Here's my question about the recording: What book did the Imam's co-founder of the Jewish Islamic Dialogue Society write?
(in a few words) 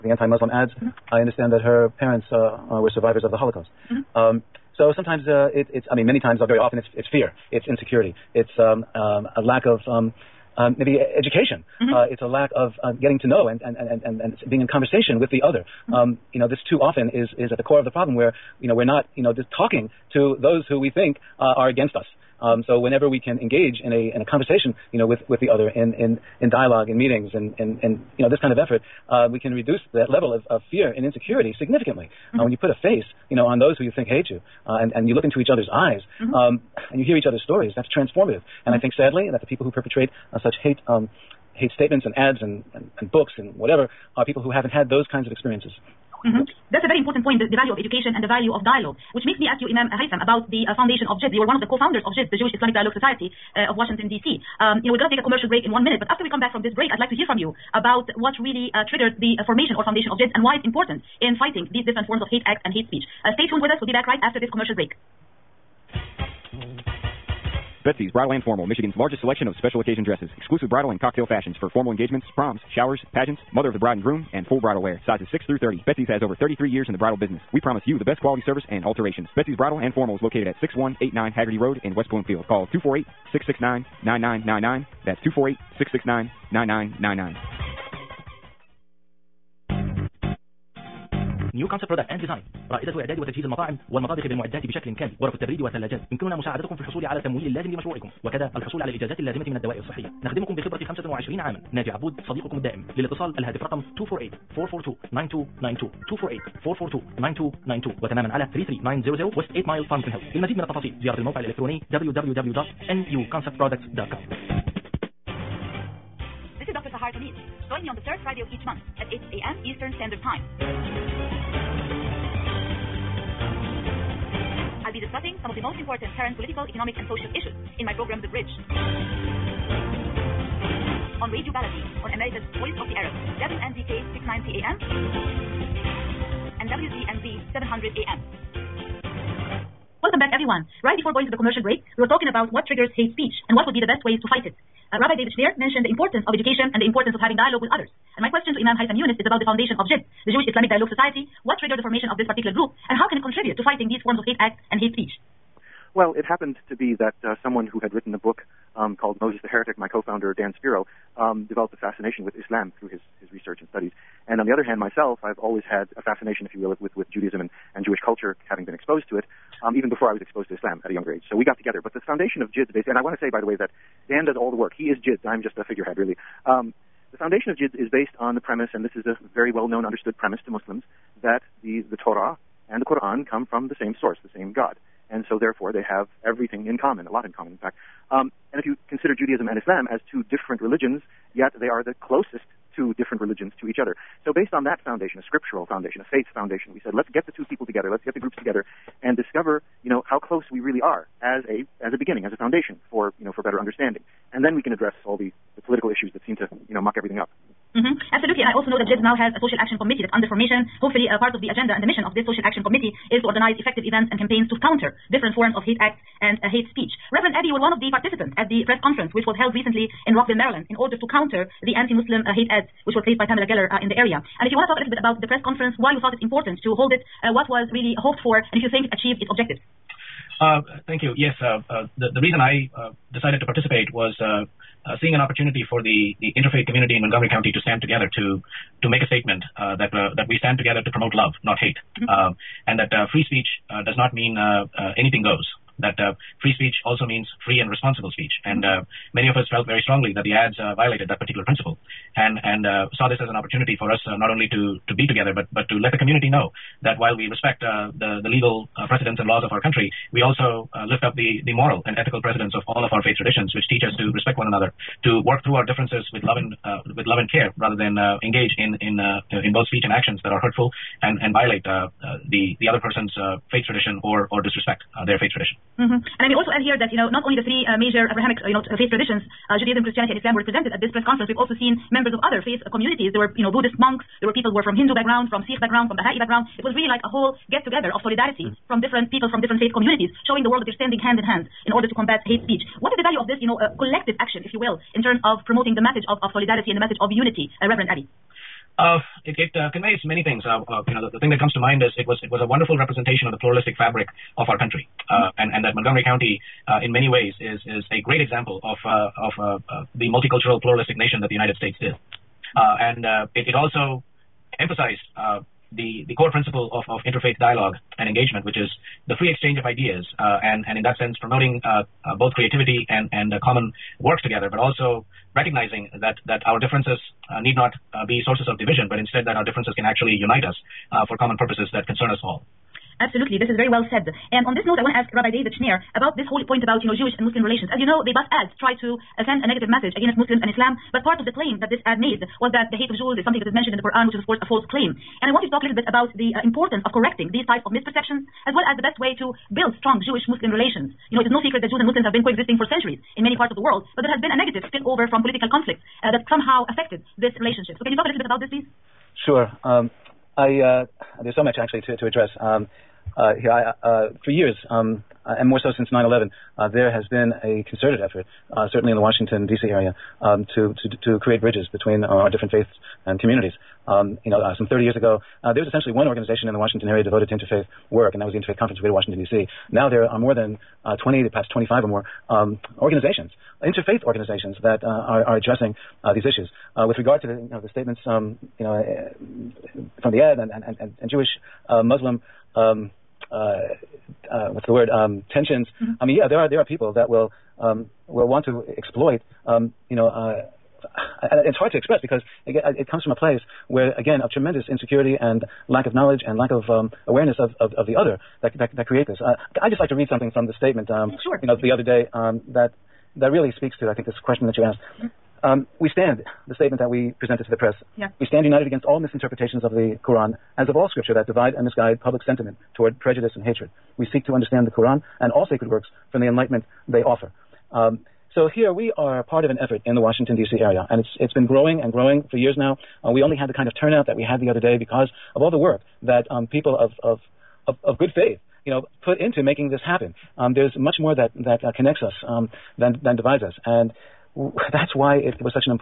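Moses the Heretic.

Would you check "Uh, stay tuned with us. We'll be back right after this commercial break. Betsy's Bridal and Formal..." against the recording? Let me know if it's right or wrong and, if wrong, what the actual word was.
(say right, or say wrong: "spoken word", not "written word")
right.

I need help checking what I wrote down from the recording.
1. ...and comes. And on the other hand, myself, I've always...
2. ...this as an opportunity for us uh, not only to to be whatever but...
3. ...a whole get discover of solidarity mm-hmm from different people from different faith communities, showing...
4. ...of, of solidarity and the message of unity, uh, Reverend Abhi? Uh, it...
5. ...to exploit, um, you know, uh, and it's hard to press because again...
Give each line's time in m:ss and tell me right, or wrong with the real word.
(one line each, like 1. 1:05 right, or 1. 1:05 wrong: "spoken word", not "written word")
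1. 2:43 wrong: "studies", not "comes"
2. 4:13 wrong: "together", not "whatever"
3. 4:47 wrong: "together", not "discover"
4. 4:56 right
5. 6:38 wrong: "express", not "press".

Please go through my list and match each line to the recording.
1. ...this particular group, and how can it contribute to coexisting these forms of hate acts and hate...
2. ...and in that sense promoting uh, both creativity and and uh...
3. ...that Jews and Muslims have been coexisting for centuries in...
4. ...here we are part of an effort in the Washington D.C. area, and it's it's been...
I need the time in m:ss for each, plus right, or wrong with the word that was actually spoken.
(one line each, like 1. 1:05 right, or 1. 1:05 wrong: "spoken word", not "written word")
1. 2:32 wrong: "fighting", not "coexisting"
2. 5:20 right
3. 5:51 right
4. 7:08 right.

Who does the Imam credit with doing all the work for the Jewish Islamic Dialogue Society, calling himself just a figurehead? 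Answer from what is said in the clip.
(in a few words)
Dan Spiro.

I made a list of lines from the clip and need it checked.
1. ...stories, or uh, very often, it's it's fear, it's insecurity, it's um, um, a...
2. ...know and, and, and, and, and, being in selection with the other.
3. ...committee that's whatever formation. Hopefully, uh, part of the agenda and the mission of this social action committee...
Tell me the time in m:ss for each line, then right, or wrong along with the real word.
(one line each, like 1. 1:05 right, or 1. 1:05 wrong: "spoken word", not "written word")
1. 0:06 wrong: "times", not "stories"
2. 0:13 wrong: "conversation", not "selection"
3. 3:29 wrong: "under", not "whatever".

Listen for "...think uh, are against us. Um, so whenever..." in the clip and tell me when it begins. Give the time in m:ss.
0:20.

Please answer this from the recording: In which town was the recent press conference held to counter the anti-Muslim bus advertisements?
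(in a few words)
Rockville, Maryland.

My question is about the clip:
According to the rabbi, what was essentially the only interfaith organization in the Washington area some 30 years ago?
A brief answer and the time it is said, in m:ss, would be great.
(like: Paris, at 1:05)
Interfaith Conference of Greater Washington, at 6:18.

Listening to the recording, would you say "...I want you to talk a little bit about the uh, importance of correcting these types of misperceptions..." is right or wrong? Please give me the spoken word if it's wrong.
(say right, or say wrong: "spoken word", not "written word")
right.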